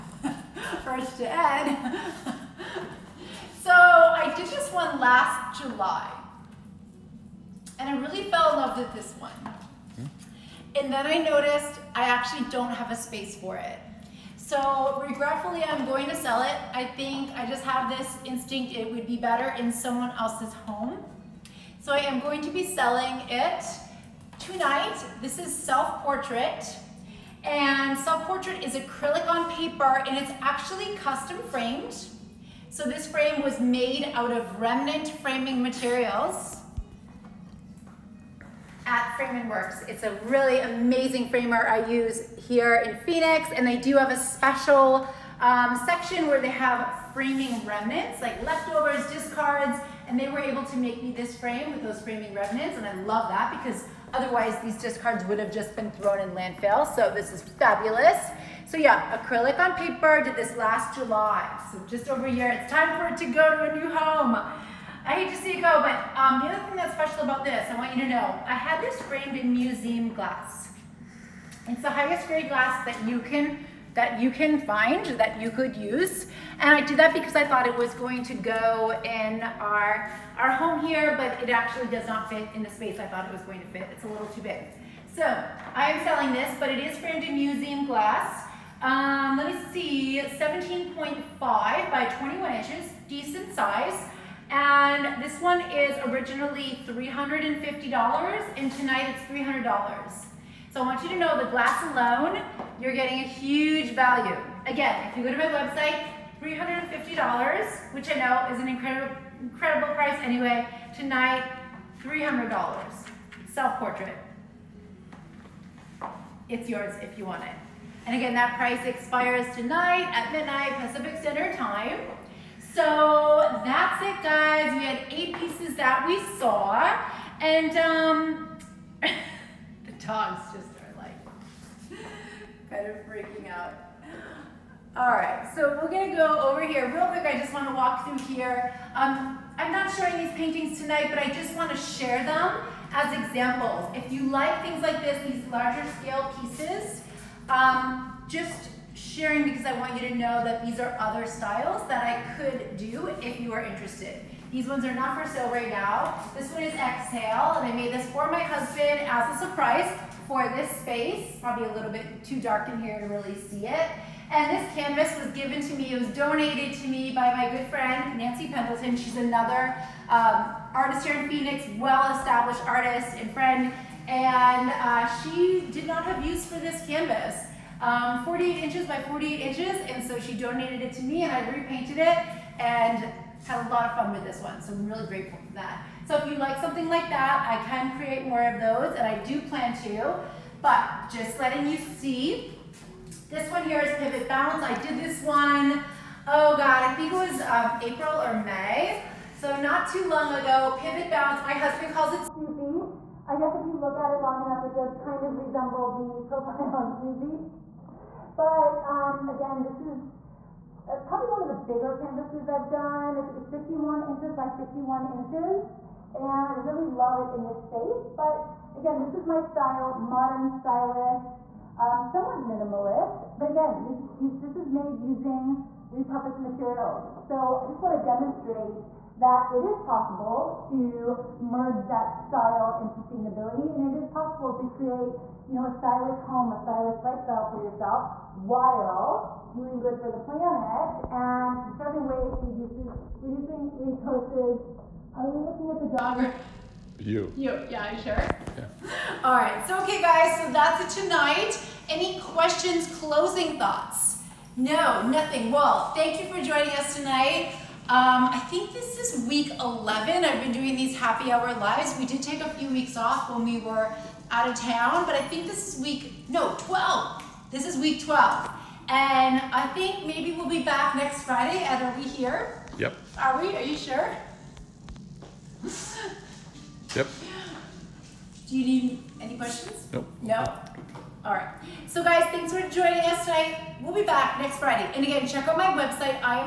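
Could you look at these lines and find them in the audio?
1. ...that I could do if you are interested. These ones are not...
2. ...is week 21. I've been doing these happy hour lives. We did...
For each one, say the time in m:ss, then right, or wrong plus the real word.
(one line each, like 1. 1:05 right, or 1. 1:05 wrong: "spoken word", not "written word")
1. 2:31 right
2. 4:18 wrong: "11", not "21".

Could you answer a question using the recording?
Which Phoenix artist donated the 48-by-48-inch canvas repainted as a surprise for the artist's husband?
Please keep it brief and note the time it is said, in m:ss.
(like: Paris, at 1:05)
Nancy Pendleton, at 2:48.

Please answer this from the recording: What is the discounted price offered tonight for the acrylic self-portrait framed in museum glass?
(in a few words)
$300.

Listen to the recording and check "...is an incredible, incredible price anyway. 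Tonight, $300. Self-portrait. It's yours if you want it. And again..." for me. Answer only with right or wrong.
right.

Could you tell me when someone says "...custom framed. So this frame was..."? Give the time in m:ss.
0:30.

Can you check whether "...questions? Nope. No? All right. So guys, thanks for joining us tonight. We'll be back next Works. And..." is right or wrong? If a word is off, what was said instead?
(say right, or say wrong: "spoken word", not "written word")
wrong: "Friday", not "Works".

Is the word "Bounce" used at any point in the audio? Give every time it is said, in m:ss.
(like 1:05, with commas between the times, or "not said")
3:14, 3:21.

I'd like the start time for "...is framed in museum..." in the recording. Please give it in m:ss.
1:26.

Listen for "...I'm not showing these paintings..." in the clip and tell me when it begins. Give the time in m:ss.
2:19.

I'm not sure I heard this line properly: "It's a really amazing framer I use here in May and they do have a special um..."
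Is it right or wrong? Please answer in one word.
wrong.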